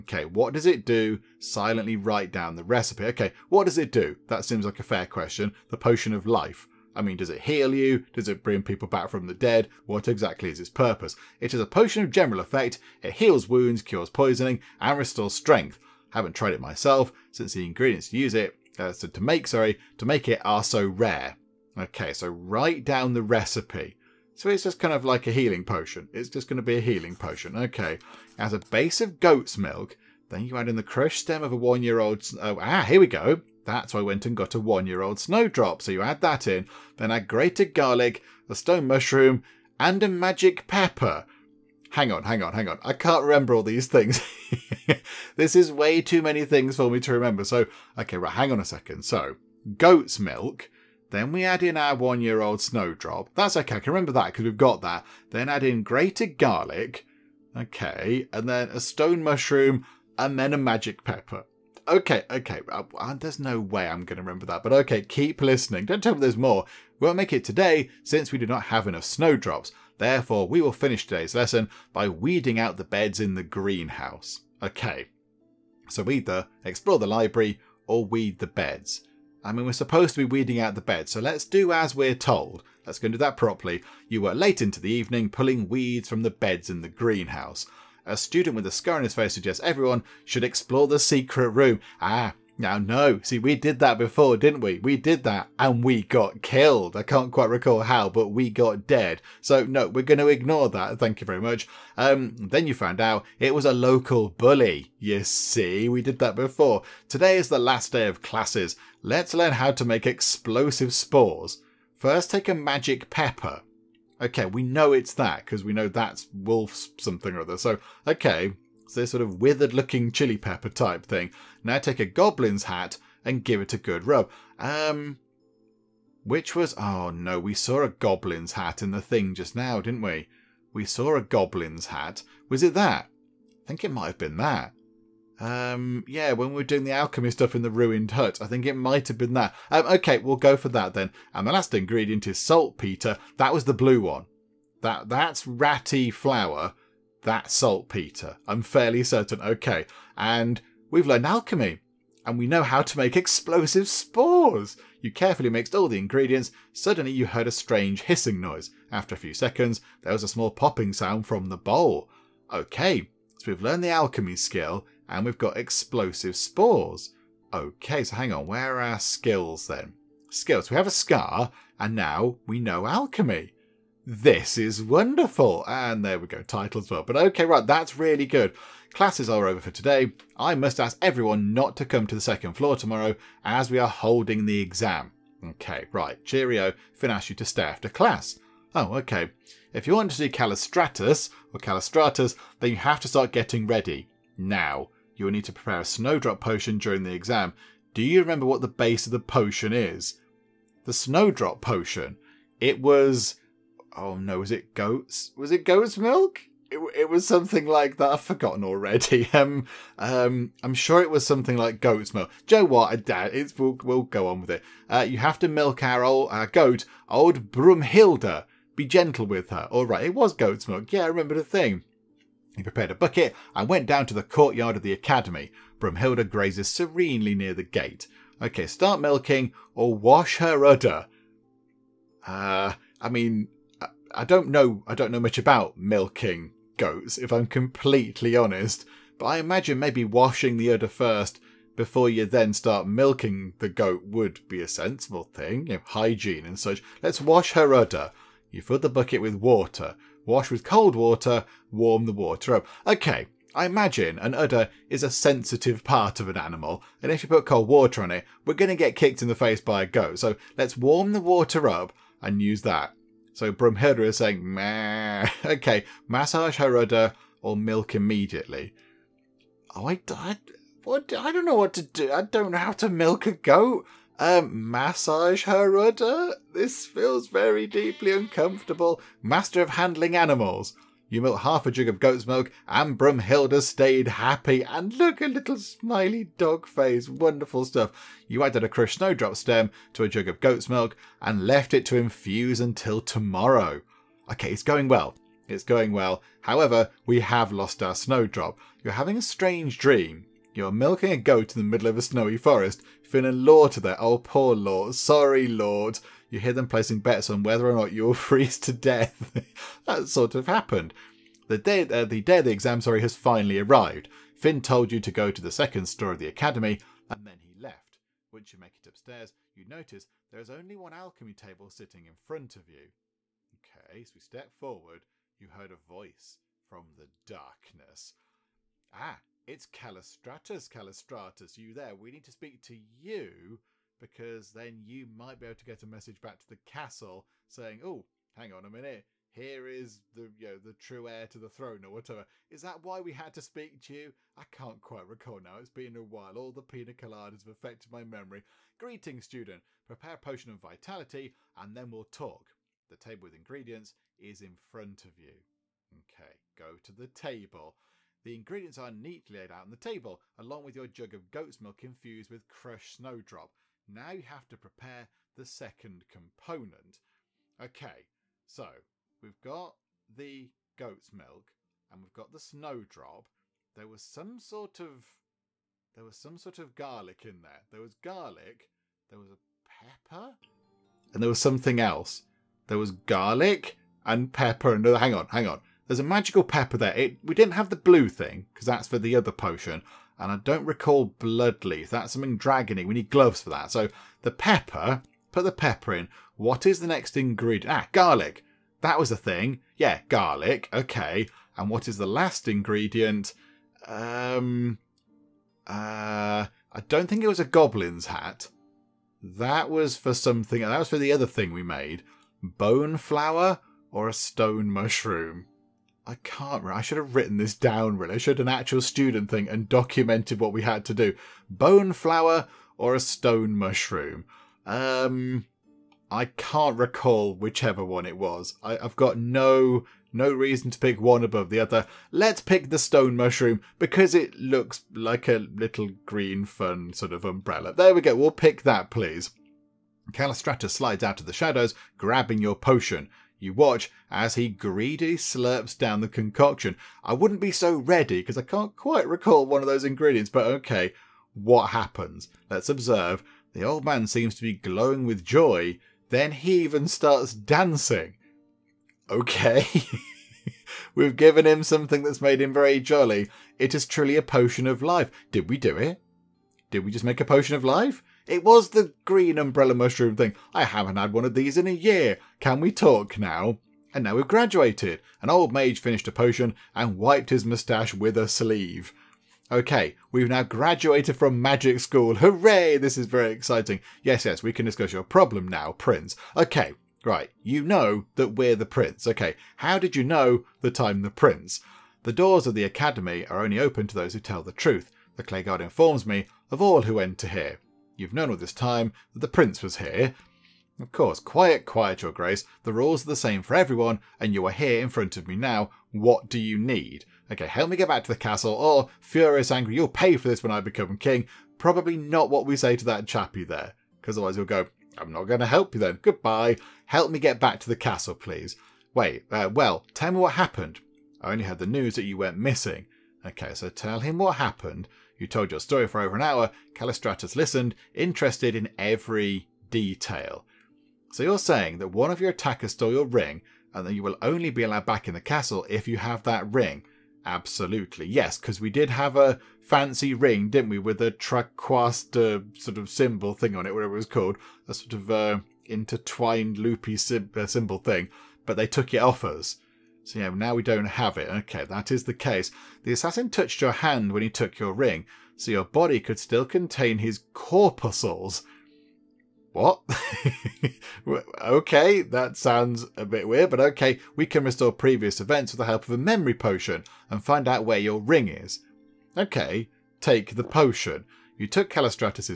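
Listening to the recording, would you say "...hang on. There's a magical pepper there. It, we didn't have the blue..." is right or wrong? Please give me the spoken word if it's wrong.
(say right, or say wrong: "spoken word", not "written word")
right.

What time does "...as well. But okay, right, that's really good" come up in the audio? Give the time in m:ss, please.
2:56.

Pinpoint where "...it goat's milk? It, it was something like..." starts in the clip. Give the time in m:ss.
3:25.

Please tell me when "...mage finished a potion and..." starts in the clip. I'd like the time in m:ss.
7:55.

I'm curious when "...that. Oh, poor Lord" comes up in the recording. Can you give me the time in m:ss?
5:03.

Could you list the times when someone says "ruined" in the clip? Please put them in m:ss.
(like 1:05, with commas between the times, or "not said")
2:17.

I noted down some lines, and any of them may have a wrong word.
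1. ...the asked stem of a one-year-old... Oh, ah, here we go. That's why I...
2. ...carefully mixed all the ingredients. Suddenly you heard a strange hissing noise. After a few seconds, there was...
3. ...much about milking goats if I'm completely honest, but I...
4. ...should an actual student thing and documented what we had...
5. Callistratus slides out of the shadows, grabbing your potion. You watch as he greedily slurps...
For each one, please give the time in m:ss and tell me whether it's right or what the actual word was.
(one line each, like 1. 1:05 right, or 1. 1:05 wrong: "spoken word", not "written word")
1. 0:30 wrong: "crushed", not "asked"
2. 2:35 right
3. 3:55 right
4. 6:58 right
5. 7:20 right.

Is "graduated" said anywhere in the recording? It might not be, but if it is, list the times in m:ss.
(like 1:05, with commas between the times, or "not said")
7:54, 8:00.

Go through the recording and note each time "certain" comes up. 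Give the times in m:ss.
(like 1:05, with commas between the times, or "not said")
2:29.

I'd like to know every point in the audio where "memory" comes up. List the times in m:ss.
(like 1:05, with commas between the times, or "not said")
5:48, 9:25.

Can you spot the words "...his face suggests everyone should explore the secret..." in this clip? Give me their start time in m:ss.
1:29.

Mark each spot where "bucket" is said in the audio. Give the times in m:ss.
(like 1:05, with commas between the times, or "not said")
3:42, 4:08.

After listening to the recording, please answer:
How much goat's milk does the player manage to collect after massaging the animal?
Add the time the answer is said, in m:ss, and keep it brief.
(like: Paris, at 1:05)
Half a jug, at 4:41.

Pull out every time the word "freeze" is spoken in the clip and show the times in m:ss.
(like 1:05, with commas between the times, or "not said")
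5:08.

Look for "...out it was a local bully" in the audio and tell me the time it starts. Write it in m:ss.
1:42.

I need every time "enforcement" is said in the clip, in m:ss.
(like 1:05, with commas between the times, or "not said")
not said.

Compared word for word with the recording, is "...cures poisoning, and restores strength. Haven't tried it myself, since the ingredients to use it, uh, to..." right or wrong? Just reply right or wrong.
right.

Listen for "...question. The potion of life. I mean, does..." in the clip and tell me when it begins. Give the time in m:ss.
0:05.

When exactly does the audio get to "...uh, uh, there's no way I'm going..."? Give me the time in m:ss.
1:02.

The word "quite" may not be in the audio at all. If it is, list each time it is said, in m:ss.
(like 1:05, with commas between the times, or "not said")
1:37, 5:44, 7:28.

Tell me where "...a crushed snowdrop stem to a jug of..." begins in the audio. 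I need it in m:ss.
4:48.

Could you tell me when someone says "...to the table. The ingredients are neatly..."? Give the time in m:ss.
5:56.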